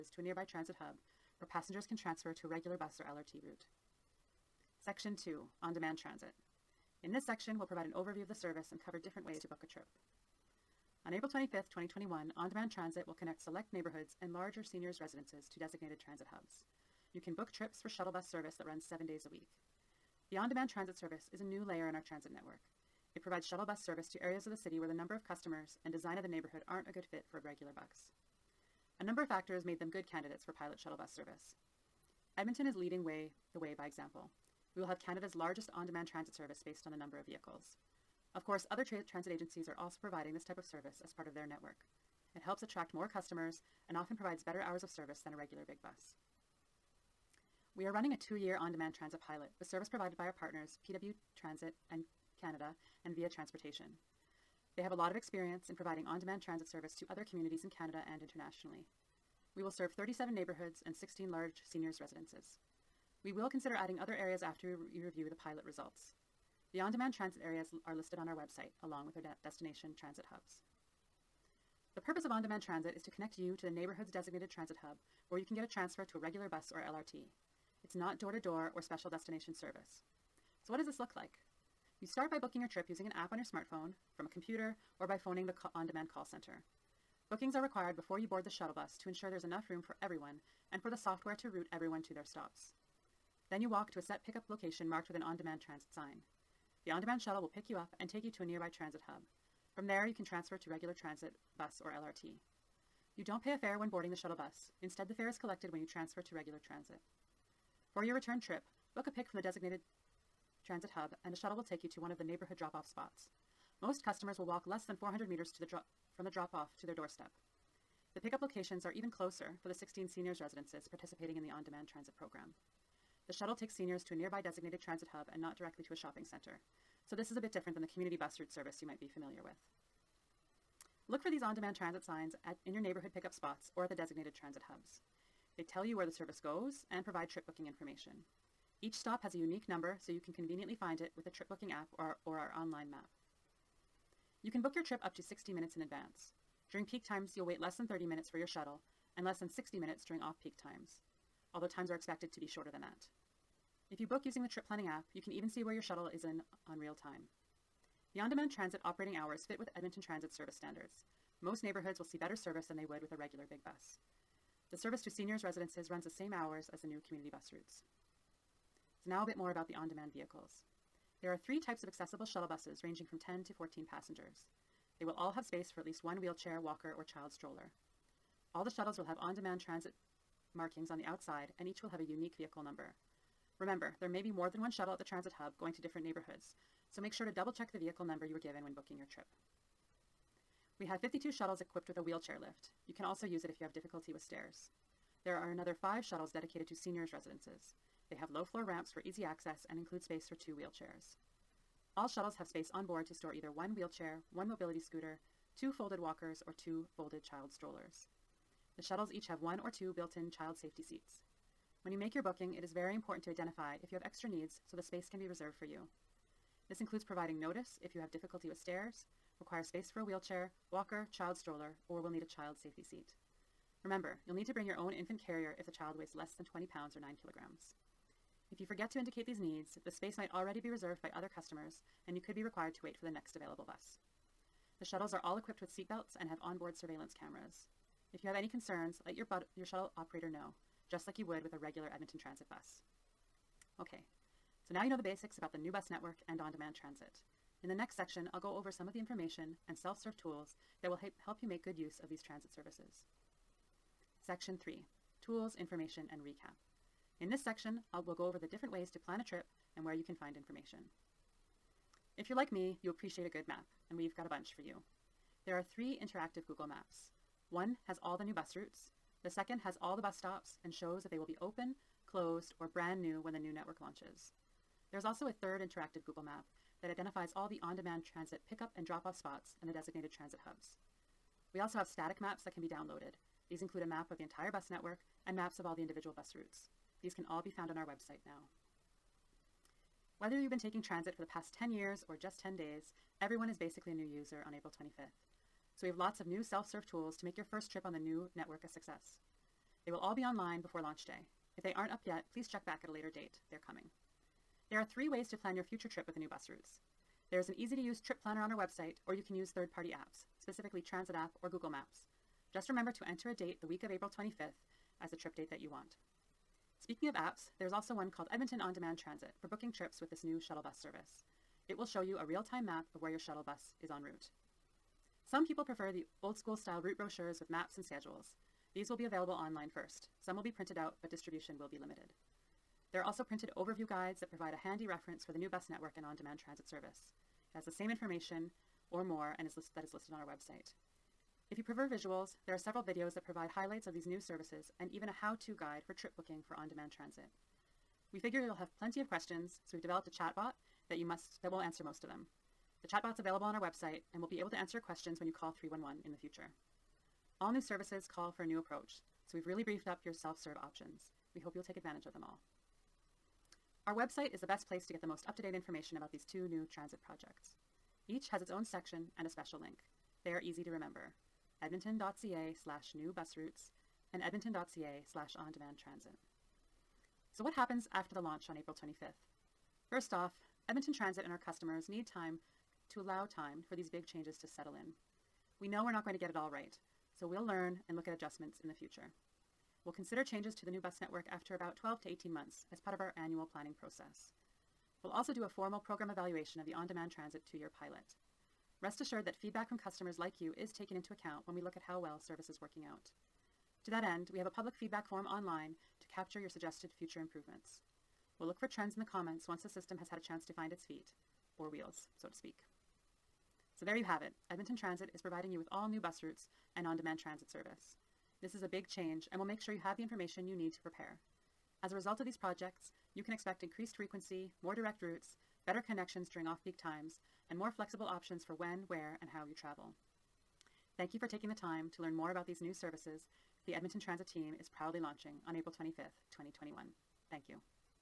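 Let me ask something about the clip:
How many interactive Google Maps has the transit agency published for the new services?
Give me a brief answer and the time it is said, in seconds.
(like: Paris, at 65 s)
3, at 265 s.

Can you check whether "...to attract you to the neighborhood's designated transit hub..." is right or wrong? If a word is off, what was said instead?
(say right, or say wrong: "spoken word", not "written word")
wrong: "connect", not "attract".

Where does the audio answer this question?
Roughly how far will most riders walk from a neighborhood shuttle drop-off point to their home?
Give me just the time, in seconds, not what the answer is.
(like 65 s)
114 s.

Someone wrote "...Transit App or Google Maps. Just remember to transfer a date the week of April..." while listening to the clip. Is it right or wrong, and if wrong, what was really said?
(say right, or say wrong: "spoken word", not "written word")
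wrong: "enter", not "transfer".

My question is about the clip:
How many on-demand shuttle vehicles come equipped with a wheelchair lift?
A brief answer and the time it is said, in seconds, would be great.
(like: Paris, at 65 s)
52, at 191 s.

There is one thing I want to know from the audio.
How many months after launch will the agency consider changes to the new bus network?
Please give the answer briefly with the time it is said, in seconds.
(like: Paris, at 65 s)
12 to 18 months, at 391 s.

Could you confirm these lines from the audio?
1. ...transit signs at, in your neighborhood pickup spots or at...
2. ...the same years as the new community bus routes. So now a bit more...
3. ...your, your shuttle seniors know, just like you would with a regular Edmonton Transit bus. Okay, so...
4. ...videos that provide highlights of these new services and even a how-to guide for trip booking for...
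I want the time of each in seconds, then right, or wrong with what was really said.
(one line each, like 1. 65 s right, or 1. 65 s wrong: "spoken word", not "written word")
1. 131 s right
2. 166 s wrong: "hours", not "years"
3. 239 s wrong: "operator", not "seniors"
4. 342 s right.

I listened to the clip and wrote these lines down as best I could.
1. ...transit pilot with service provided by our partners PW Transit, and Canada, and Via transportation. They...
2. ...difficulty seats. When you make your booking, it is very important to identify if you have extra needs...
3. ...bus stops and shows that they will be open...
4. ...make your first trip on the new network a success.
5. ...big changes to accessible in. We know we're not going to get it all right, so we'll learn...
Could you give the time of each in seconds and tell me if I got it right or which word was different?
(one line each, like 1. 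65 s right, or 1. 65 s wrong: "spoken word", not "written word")
1. 48 s right
2. 210 s wrong: "safety", not "difficulty"
3. 270 s right
4. 297 s right
5. 383 s wrong: "settle", not "accessible".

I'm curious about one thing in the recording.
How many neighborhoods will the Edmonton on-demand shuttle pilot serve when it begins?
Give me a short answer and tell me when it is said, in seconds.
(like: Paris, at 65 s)
37, at 59 s.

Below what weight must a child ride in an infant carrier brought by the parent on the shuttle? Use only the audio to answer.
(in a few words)
20 pounds.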